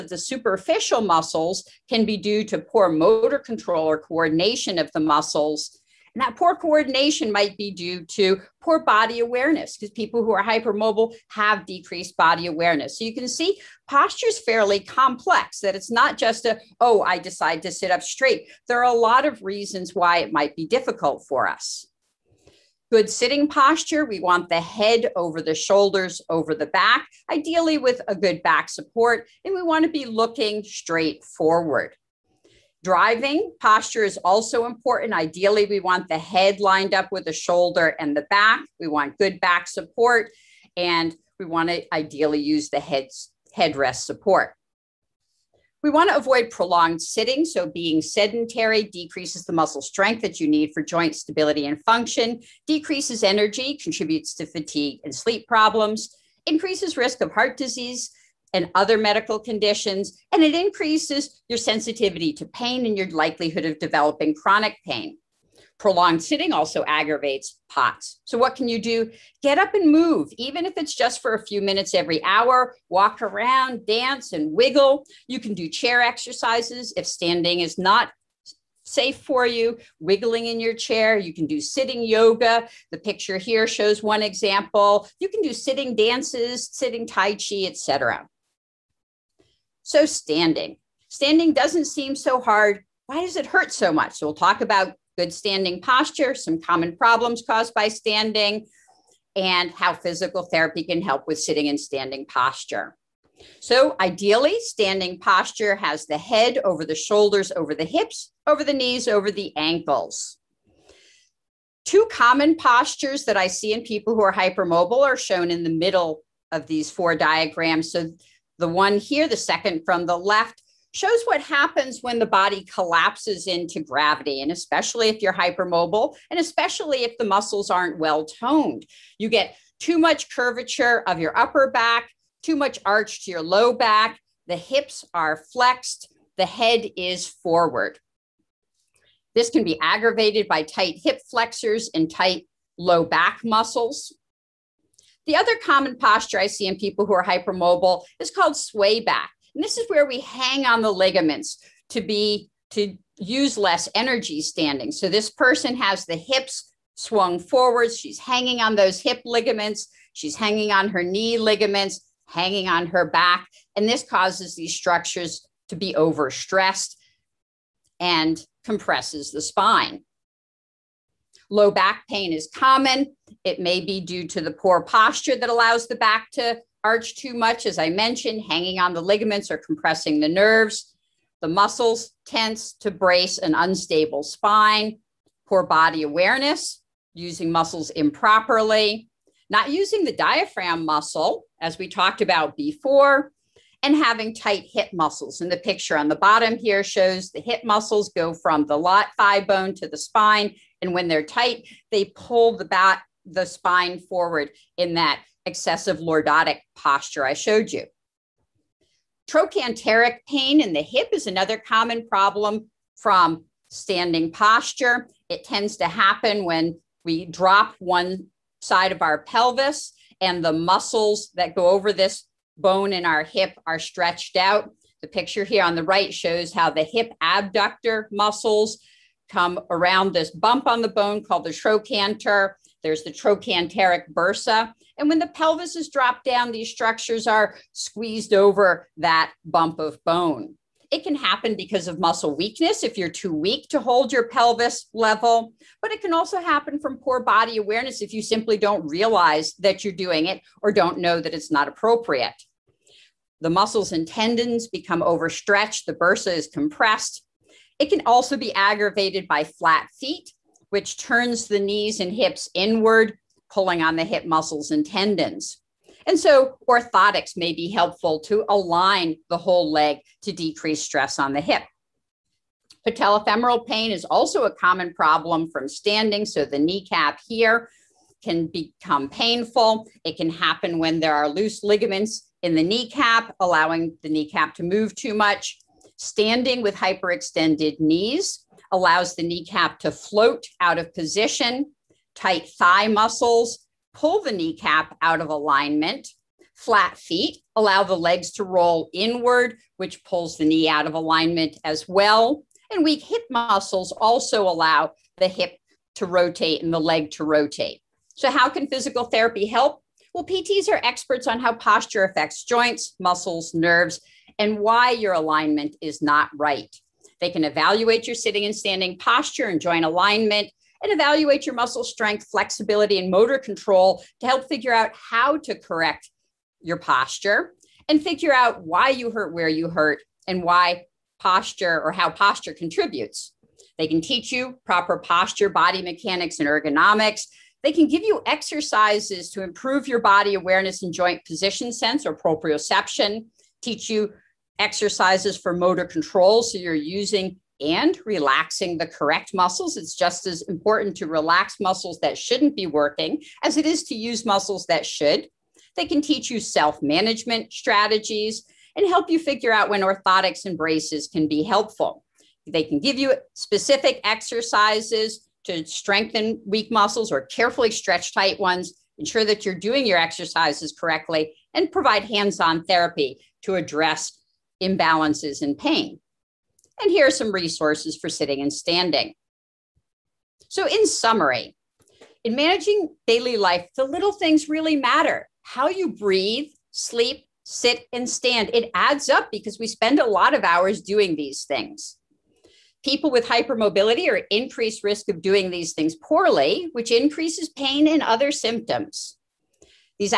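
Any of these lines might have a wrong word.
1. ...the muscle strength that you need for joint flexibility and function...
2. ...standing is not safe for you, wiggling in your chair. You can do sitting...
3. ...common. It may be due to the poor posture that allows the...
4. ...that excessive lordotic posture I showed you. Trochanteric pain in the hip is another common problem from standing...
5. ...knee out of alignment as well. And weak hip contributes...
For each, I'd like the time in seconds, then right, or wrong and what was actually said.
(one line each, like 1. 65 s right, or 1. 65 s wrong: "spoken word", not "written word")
1. 49 s wrong: "stability", not "flexibility"
2. 77 s right
3. 172 s right
4. 204 s right
5. 300 s wrong: "muscles", not "contributes".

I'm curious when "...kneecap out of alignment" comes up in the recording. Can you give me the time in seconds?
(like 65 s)
294 s.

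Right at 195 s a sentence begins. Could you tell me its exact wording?
And the picture on the bottom here shows the hip muscles go from the lot thigh bone to the spine.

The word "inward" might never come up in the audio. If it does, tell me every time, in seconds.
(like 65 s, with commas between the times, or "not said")
262 s, 298 s.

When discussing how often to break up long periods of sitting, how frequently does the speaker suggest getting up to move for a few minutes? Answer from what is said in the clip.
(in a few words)
every hour.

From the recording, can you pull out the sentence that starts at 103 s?
So, ideally, standing posture has the head over the shoulders, over the hips, over the knees, over the ankles.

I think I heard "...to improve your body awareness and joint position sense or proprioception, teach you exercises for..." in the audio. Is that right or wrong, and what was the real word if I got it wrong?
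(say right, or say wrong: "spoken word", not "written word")
right.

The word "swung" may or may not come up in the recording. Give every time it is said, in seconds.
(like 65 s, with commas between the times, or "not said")
156 s.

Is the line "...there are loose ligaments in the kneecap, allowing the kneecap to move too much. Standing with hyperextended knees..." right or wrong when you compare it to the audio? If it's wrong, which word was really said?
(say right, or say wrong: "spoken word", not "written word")
right.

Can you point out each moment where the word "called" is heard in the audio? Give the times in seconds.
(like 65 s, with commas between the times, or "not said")
148 s, 231 s.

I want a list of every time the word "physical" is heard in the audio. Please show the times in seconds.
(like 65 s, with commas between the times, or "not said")
99 s, 308 s.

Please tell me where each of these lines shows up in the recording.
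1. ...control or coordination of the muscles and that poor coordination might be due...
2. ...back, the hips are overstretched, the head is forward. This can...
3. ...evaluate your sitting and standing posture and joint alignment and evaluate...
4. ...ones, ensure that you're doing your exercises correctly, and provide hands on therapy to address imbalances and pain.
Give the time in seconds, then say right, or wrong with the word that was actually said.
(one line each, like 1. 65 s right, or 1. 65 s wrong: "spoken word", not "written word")
1. 3 s right
2. 133 s wrong: "flexed", not "overstretched"
3. 317 s right
4. 368 s right.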